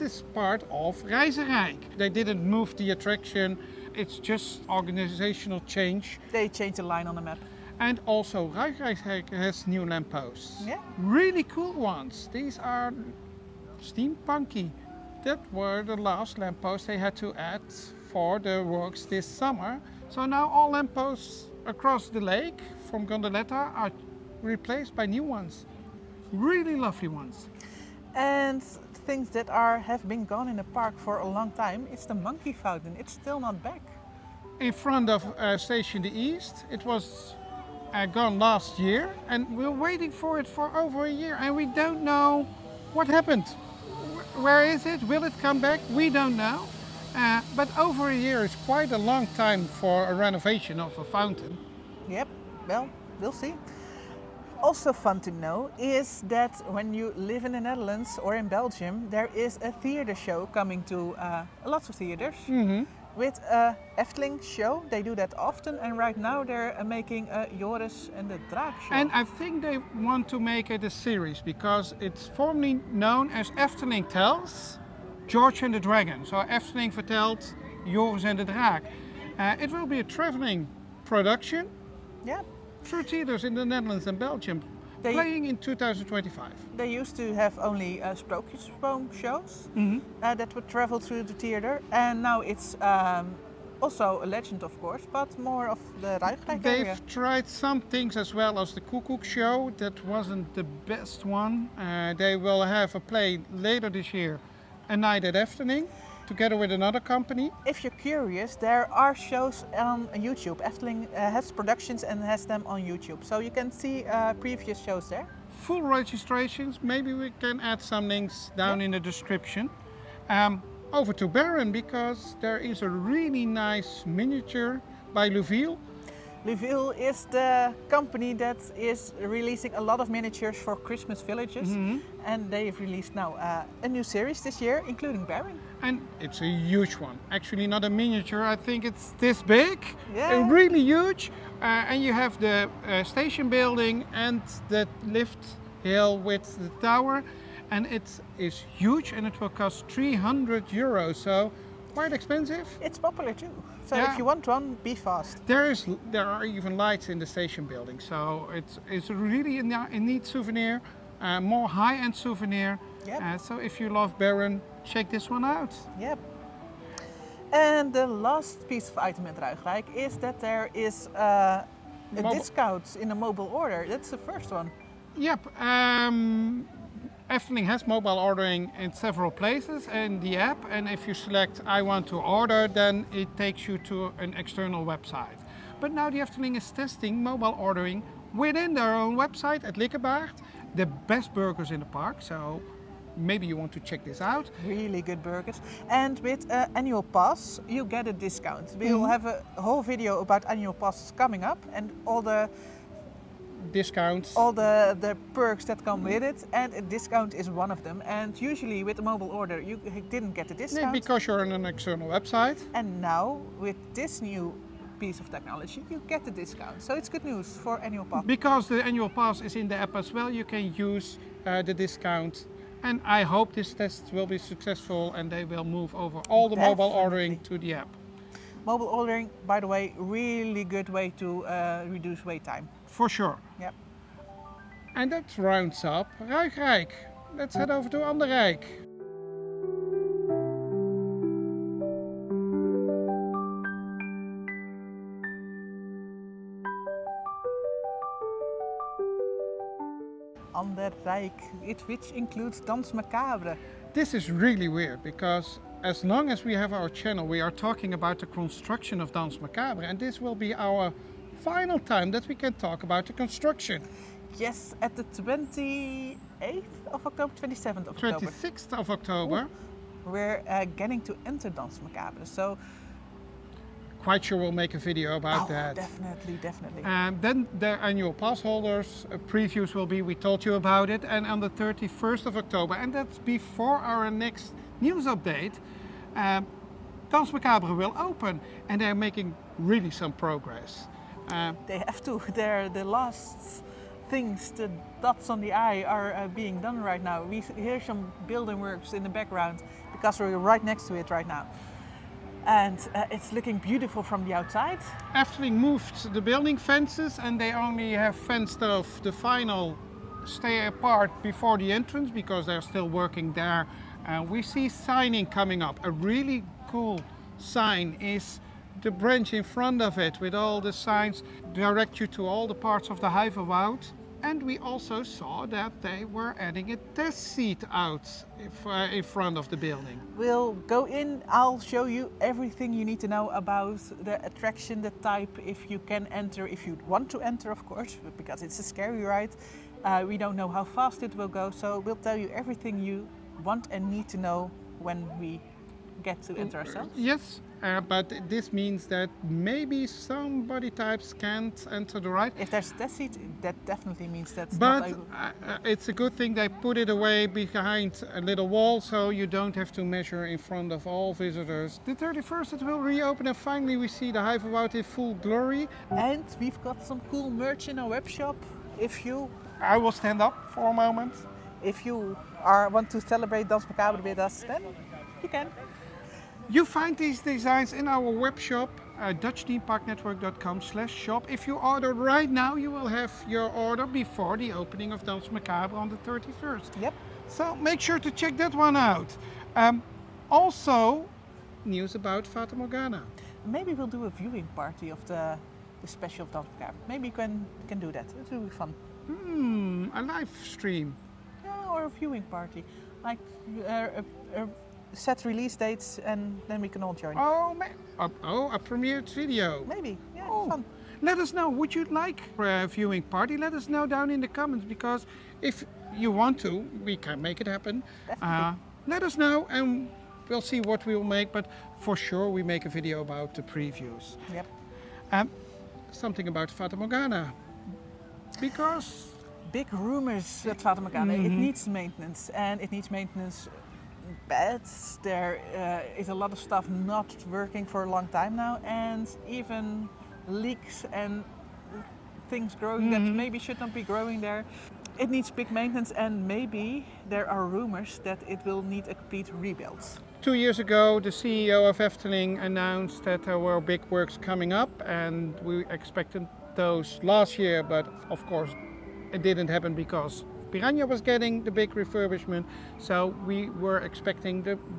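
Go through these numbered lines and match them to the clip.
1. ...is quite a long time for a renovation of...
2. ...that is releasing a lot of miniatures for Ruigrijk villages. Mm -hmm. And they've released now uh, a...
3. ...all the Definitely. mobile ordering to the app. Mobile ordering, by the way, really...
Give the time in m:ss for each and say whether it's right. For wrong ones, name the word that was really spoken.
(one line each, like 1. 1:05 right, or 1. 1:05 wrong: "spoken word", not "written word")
1. 0:48 right
2. 2:08 wrong: "Christmas", not "Ruigrijk"
3. 3:46 right.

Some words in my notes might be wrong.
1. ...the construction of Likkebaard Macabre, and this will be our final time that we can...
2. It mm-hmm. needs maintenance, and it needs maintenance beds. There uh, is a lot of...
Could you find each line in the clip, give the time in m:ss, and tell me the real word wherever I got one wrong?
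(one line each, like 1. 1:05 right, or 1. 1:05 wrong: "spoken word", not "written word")
1. 4:18 wrong: "Danse", not "Likkebaard"
2. 7:11 right.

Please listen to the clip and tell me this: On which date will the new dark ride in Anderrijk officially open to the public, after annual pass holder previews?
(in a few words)
31st of October.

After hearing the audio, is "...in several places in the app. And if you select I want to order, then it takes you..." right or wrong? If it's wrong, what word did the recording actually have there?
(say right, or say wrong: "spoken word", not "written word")
right.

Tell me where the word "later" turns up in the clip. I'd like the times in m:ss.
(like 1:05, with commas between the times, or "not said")
1:43.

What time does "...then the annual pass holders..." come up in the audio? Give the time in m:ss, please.
4:37.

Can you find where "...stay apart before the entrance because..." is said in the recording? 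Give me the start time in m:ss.
5:10.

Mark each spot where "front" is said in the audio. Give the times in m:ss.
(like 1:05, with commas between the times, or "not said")
0:34, 5:19, 5:29, 6:00.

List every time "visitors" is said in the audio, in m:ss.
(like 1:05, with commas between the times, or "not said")
6:01.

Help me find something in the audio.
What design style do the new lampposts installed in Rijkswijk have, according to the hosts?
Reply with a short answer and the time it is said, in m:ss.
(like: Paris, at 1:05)
Steampunky, at 0:13.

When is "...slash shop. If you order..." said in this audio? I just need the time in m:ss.
6:20.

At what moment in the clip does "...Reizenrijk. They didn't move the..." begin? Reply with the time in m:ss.
0:01.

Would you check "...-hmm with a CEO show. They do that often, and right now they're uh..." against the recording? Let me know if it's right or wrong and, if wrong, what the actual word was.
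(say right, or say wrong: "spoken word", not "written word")
wrong: "Efteling", not "CEO".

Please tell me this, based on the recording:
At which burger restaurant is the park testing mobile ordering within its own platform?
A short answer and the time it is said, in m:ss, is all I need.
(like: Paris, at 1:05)
Likkebaard, at 3:09.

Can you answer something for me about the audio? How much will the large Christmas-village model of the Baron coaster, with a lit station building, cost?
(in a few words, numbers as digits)
300 euros.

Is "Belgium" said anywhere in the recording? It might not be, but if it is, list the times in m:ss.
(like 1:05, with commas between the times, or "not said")
0:58, 1:24.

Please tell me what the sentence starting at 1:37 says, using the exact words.
tried some things as well as the cuckoo show.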